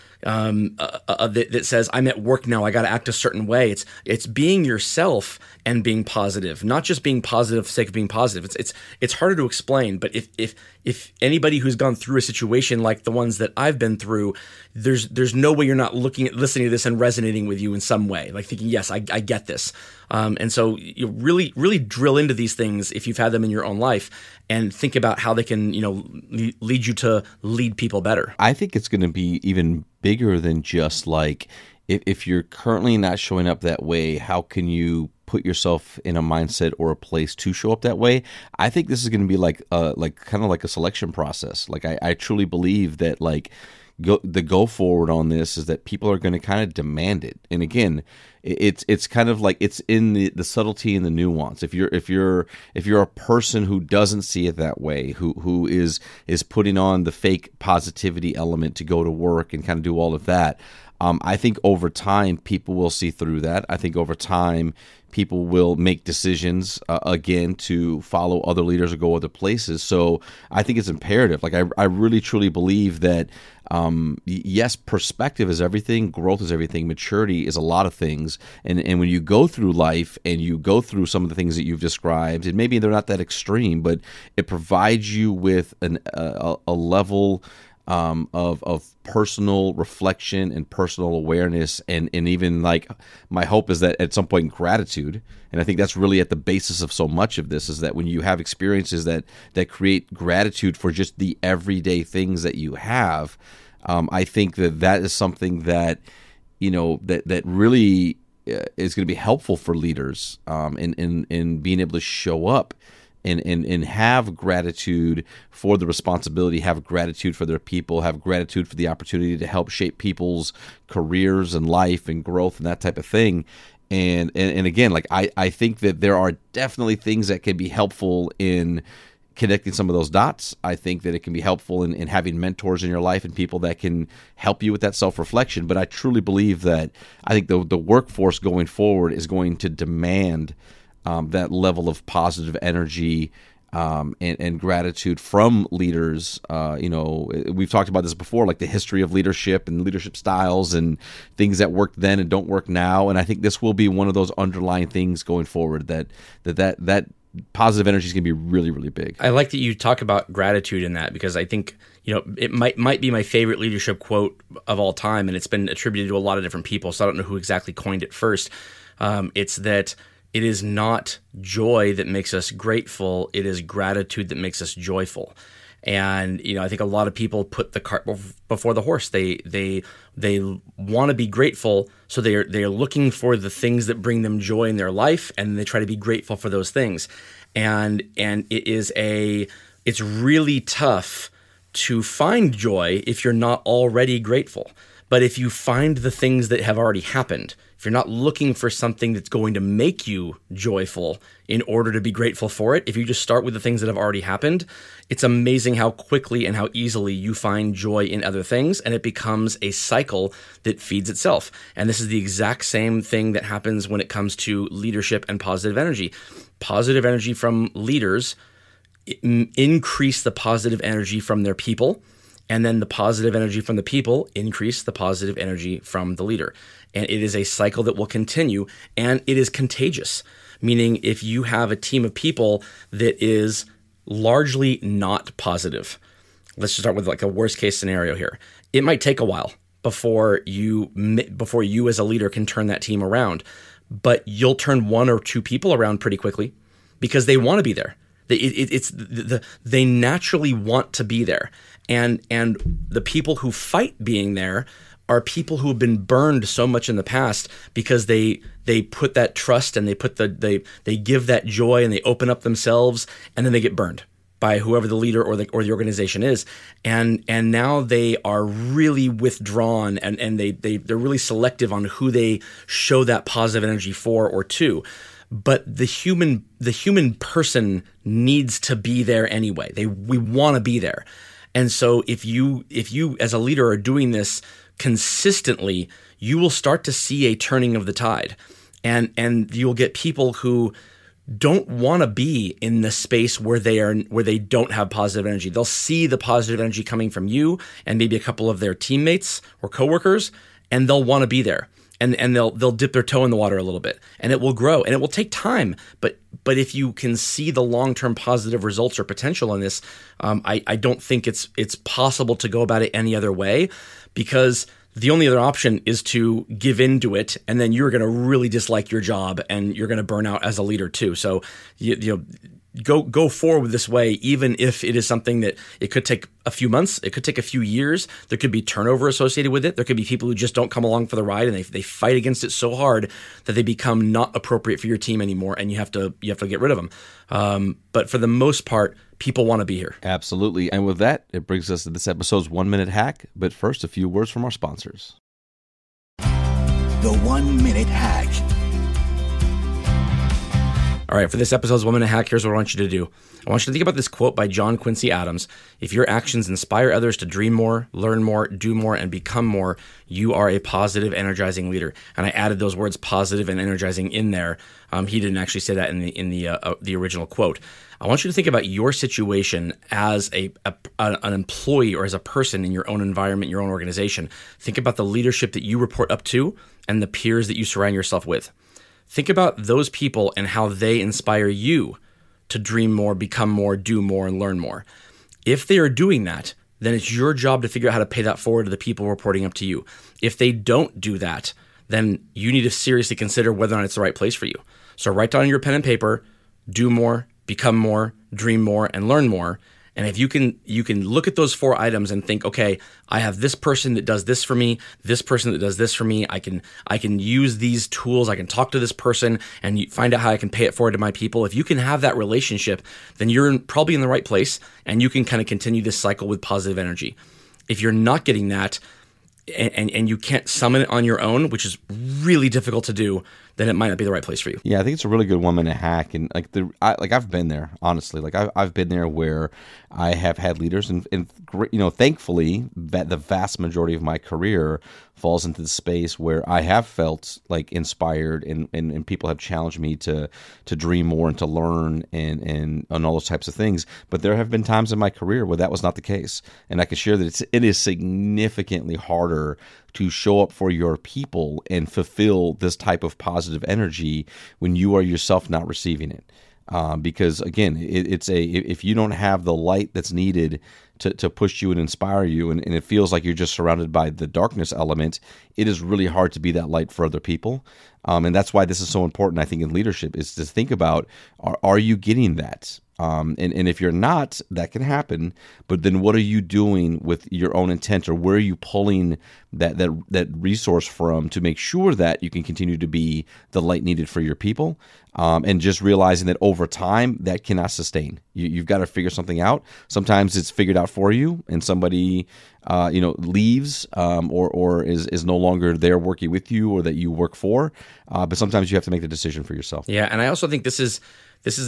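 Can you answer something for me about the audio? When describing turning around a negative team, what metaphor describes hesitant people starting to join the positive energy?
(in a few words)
dip their toe.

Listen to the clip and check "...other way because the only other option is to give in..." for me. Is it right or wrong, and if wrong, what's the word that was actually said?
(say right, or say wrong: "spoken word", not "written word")
right.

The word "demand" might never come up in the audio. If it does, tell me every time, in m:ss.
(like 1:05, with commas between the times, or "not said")
0:46, 2:19.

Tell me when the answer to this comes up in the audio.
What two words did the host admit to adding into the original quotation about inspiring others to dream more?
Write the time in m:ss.
6:02.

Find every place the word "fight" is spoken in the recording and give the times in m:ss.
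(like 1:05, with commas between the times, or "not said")
4:13, 5:31.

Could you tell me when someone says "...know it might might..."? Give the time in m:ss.
2:42.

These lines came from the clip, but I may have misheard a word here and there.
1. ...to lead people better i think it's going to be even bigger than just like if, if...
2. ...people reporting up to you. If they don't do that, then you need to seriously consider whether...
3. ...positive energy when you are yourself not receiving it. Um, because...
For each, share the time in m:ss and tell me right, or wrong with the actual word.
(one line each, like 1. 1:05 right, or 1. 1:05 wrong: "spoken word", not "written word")
1. 0:26 right
2. 6:28 right
3. 7:33 right.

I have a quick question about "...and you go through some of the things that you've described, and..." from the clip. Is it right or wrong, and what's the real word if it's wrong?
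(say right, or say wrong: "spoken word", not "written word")
right.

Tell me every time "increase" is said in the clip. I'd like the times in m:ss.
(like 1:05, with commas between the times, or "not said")
3:39, 3:44.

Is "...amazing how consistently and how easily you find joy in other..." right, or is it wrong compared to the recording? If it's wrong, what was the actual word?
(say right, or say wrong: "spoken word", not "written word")
wrong: "quickly", not "consistently".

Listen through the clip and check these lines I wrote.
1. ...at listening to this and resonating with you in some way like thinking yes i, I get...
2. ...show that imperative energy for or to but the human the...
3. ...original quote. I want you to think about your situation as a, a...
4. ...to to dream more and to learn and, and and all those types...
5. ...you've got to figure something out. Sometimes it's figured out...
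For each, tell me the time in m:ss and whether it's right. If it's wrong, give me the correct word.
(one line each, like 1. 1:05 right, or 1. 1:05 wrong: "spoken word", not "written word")
1. 0:16 right
2. 4:32 wrong: "positive", not "imperative"
3. 6:06 right
4. 7:19 right
5. 8:08 right.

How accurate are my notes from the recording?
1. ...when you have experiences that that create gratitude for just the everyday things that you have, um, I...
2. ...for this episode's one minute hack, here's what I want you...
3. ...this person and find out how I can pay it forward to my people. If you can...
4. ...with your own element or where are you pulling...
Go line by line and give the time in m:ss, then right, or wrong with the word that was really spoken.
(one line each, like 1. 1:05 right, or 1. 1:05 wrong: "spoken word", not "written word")
1. 1:37 right
2. 5:51 right
3. 6:48 right
4. 7:57 wrong: "intent", not "element".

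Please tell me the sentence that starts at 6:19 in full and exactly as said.
Think about those people and how they inspire you to dream more, become more, do more, and learn more.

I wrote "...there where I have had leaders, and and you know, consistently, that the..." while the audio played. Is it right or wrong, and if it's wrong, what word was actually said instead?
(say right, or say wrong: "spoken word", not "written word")
wrong: "thankfully", not "consistently".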